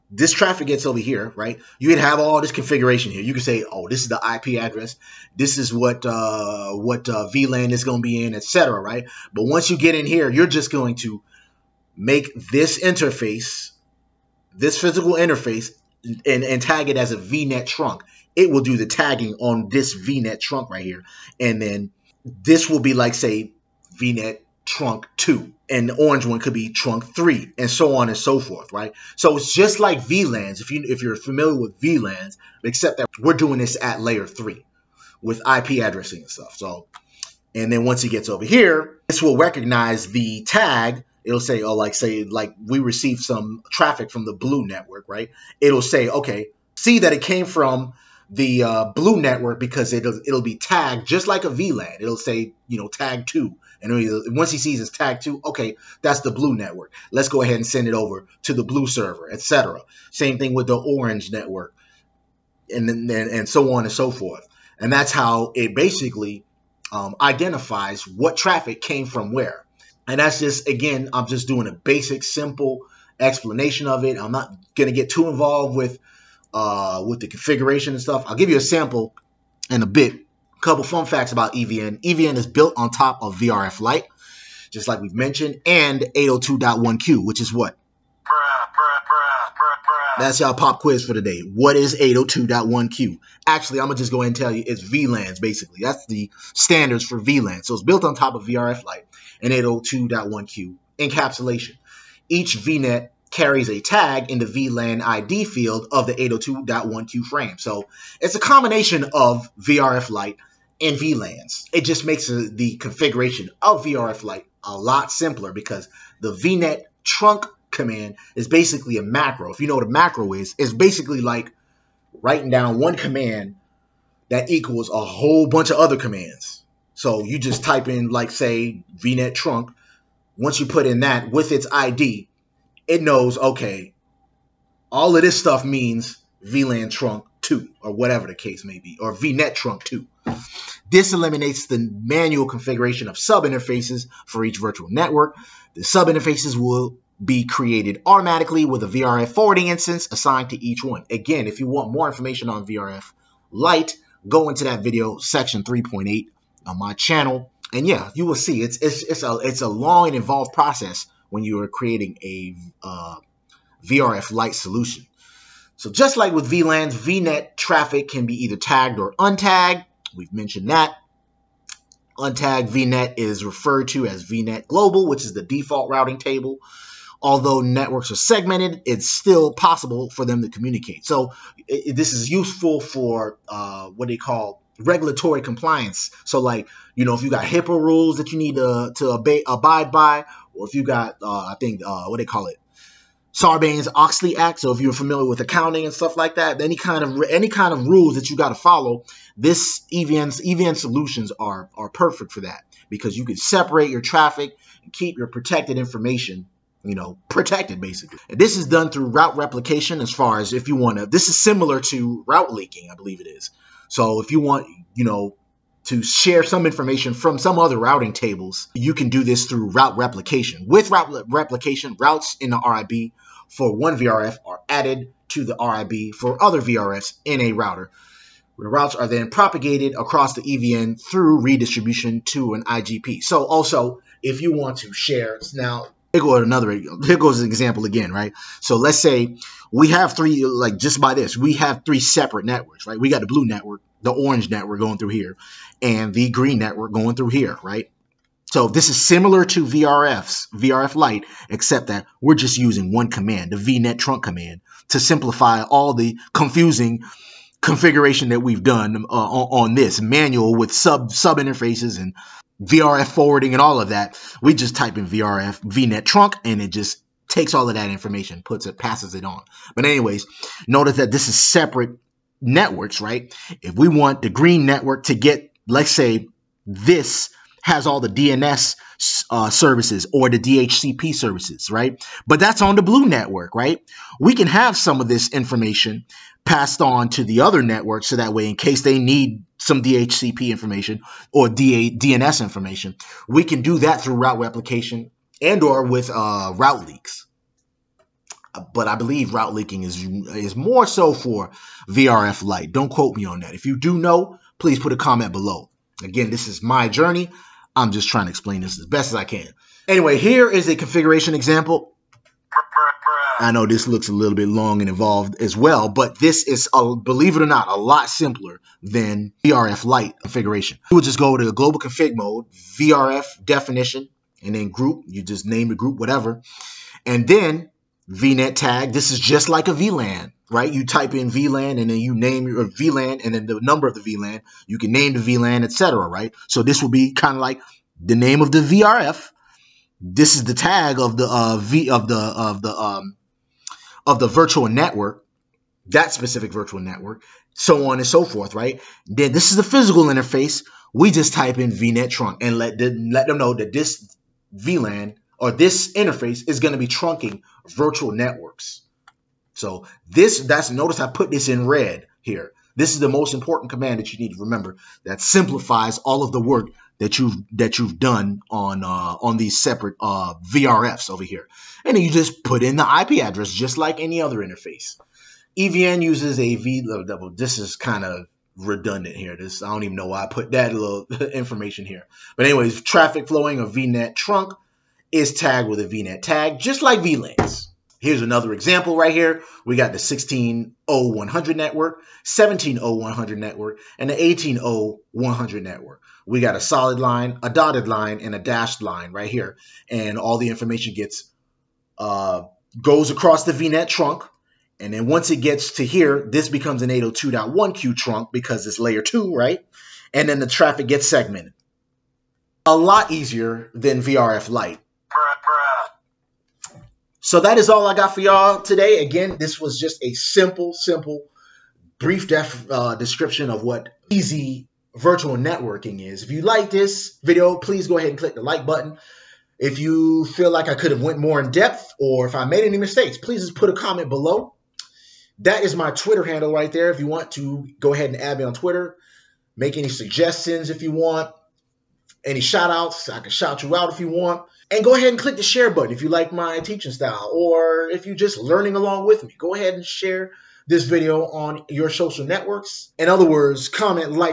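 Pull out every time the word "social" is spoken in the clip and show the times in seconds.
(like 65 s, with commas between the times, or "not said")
451 s.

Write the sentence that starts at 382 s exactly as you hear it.
But anyways, traffic flowing a VNet trunk is tagged with a VNet tag, just like VLANs.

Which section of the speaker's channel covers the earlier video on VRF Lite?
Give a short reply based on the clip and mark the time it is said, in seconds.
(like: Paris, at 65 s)
Section 3.8, at 155 s.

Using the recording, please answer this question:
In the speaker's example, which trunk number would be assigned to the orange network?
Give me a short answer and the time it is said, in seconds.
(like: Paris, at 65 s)
Trunk 3, at 26 s.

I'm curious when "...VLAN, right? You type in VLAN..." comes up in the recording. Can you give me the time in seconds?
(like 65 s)
329 s.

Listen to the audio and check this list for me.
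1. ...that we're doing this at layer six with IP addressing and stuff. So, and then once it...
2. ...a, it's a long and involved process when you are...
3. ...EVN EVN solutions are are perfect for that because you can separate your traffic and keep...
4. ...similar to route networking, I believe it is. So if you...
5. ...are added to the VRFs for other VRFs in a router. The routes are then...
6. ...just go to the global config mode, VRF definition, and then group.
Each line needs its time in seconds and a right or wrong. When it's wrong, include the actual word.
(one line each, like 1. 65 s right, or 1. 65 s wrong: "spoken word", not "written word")
1. 32 s wrong: "three", not "six"
2. 159 s right
3. 199 s right
4. 211 s wrong: "leaking", not "networking"
5. 224 s wrong: "RIB", not "VRFs"
6. 321 s right.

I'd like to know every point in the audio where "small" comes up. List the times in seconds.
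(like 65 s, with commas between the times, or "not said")
not said.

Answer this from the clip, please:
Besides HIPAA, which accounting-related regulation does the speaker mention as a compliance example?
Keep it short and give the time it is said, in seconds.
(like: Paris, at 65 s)
Sarbanes Oxley Act, at 193 s.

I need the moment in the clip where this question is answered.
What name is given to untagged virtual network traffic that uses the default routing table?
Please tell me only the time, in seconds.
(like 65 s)
174 s.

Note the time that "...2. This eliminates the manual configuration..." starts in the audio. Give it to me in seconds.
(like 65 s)
139 s.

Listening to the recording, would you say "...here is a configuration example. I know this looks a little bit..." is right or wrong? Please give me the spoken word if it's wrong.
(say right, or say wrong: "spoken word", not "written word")
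right.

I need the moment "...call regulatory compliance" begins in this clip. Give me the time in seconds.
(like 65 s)
184 s.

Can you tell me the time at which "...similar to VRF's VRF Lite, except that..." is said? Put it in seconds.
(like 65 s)
248 s.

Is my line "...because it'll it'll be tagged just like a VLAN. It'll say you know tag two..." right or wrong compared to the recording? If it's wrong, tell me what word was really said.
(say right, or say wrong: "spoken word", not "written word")
right.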